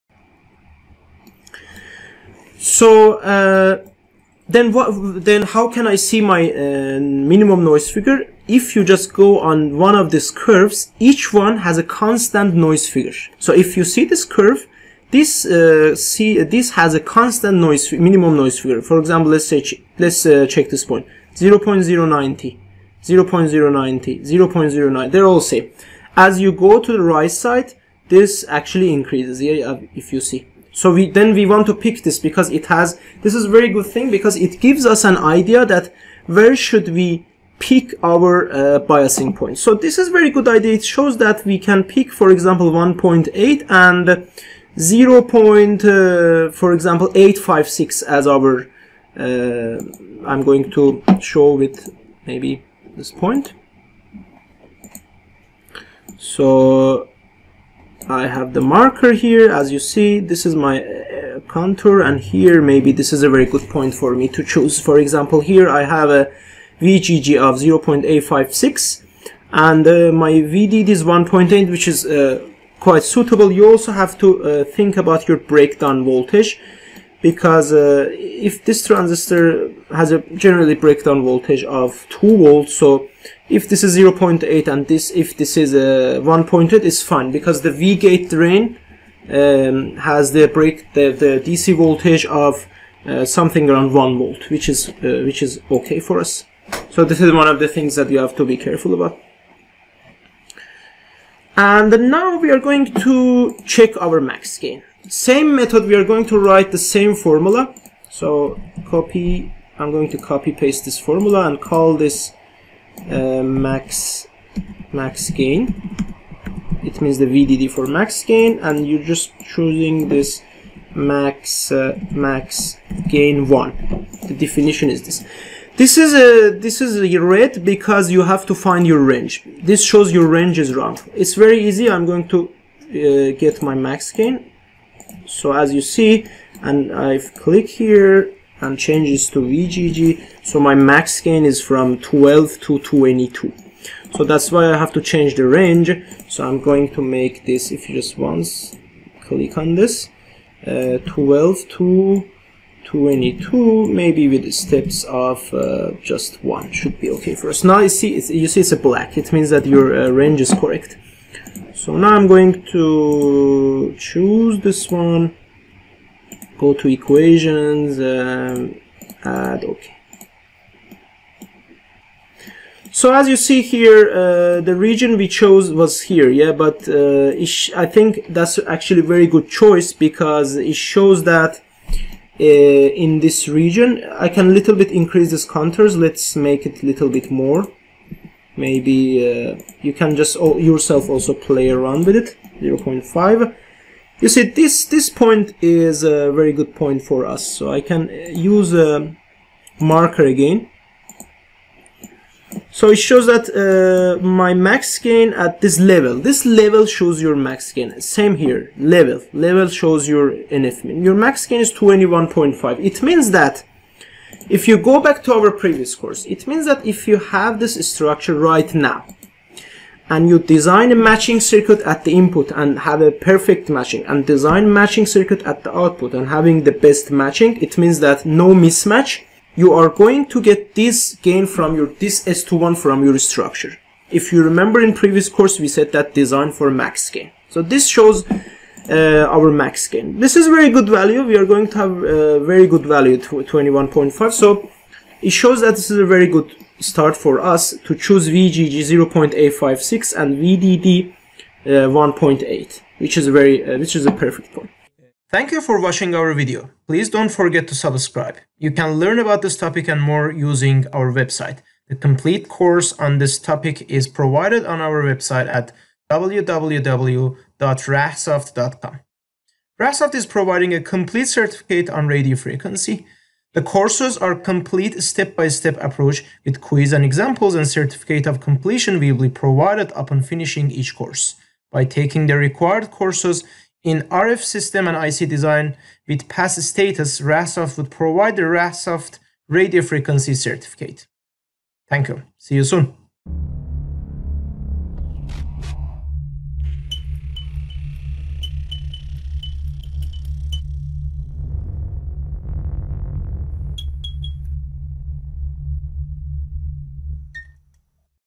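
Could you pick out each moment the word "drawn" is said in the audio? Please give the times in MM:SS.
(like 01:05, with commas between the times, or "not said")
not said.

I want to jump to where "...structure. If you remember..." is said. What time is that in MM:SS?
03:53.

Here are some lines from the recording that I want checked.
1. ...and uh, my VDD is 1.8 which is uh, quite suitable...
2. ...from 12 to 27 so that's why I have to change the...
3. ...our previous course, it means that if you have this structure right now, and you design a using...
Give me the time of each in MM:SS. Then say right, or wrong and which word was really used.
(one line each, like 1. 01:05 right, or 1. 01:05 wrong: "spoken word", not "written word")
1. 01:09 right
2. 02:21 wrong: "22", not "27"
3. 03:35 wrong: "matching", not "using".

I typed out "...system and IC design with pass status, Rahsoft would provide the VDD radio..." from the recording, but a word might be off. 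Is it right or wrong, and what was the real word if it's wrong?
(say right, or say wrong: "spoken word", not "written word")
wrong: "Rahsoft", not "VDD".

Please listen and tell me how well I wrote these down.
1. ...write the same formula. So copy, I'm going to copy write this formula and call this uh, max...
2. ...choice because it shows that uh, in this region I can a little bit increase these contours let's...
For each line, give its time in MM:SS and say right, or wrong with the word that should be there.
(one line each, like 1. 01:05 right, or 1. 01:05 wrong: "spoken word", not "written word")
1. 01:46 wrong: "paste", not "write"
2. 02:59 right.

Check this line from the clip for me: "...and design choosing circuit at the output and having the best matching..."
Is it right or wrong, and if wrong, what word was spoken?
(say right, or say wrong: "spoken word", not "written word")
wrong: "matching", not "choosing".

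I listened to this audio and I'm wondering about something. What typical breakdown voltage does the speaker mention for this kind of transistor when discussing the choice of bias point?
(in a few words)
2 volts.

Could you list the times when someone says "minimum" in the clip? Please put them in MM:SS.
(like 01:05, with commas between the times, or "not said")
00:07, 00:17.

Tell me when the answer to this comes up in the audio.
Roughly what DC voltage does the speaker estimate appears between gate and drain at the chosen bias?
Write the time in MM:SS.
01:33.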